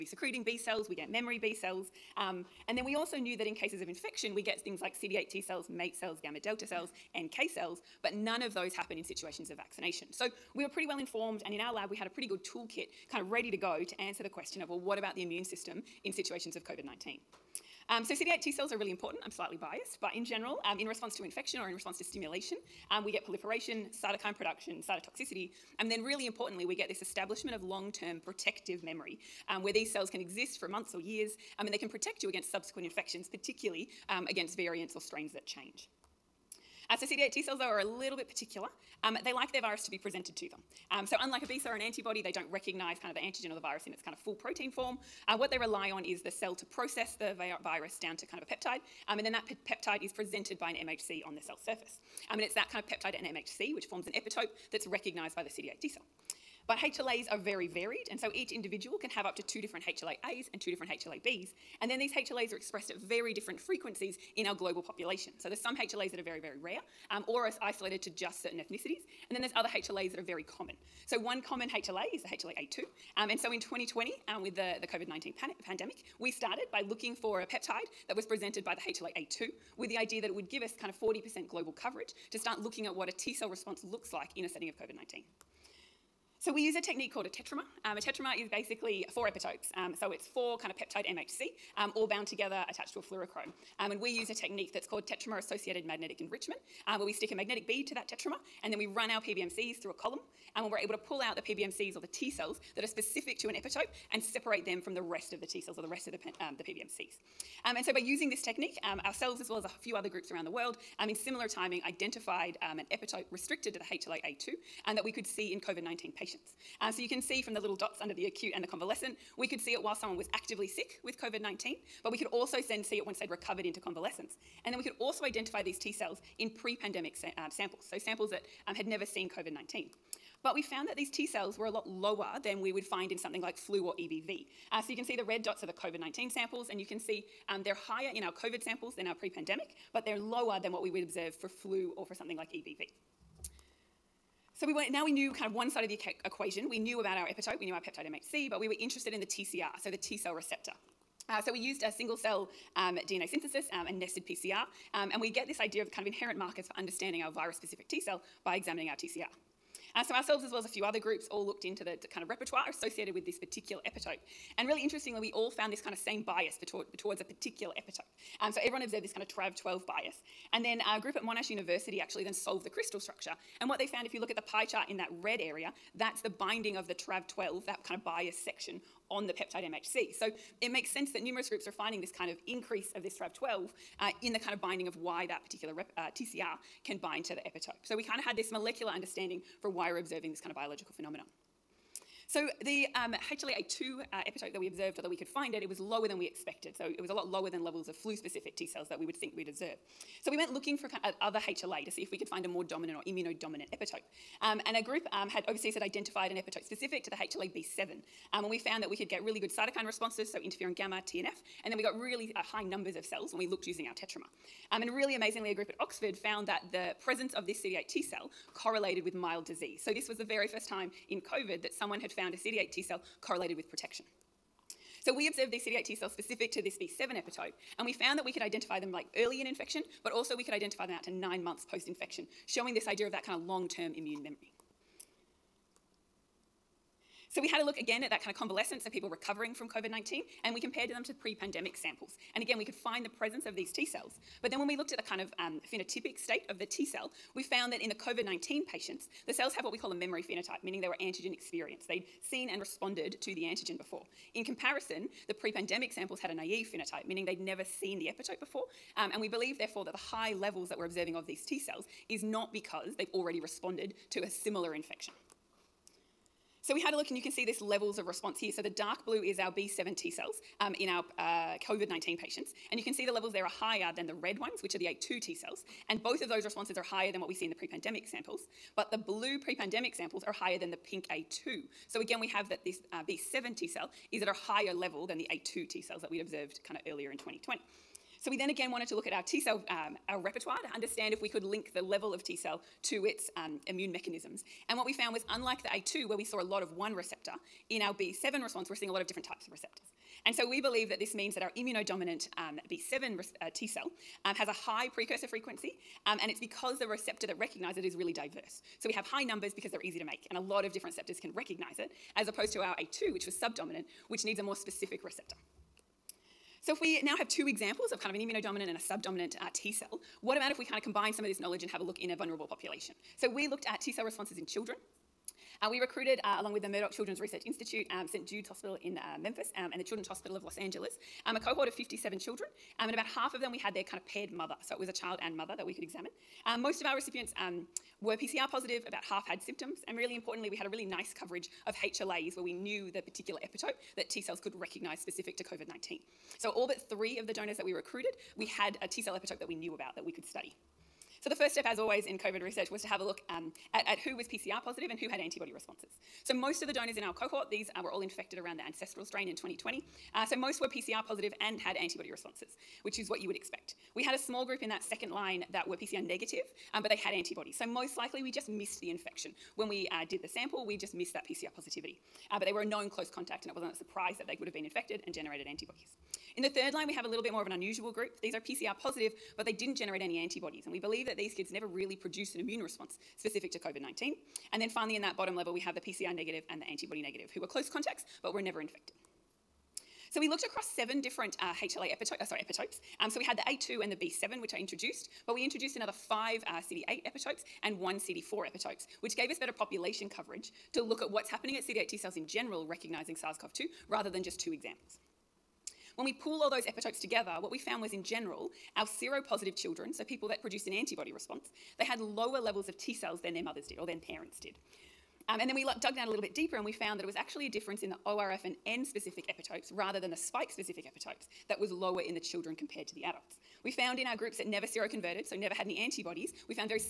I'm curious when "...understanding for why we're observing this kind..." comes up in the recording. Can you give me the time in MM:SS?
03:08.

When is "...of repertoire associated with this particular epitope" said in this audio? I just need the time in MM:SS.
02:42.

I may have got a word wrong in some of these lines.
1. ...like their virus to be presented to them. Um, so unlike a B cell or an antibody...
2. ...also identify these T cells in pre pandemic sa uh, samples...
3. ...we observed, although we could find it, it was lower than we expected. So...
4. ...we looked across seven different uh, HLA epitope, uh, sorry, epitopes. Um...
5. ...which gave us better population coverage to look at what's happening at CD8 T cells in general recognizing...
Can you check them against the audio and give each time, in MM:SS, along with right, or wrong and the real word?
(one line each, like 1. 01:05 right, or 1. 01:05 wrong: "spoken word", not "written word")
1. 00:39 right
2. 02:04 right
3. 03:14 right
4. 06:30 right
5. 06:39 right.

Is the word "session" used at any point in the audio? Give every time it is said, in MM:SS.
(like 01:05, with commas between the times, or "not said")
not said.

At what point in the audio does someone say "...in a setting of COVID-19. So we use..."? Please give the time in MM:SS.
01:24.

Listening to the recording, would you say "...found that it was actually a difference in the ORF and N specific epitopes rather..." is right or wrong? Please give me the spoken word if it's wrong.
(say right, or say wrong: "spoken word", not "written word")
right.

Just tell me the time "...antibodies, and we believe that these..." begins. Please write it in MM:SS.
06:20.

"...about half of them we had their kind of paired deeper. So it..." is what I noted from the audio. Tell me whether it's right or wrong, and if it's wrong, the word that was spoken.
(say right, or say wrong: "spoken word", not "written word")
wrong: "mother", not "deeper".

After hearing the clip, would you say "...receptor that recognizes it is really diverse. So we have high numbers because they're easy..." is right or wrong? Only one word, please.
right.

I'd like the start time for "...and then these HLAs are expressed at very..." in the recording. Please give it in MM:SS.
01:01.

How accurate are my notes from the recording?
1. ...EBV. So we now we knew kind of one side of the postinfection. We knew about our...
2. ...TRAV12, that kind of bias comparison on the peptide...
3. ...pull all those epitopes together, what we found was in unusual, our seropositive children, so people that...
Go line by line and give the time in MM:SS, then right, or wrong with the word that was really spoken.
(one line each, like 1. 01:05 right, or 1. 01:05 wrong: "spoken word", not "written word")
1. 02:22 wrong: "equation", not "postinfection"
2. 02:56 wrong: "section", not "comparison"
3. 06:46 wrong: "general", not "unusual".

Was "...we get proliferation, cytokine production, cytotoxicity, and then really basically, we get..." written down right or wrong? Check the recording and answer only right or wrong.
wrong.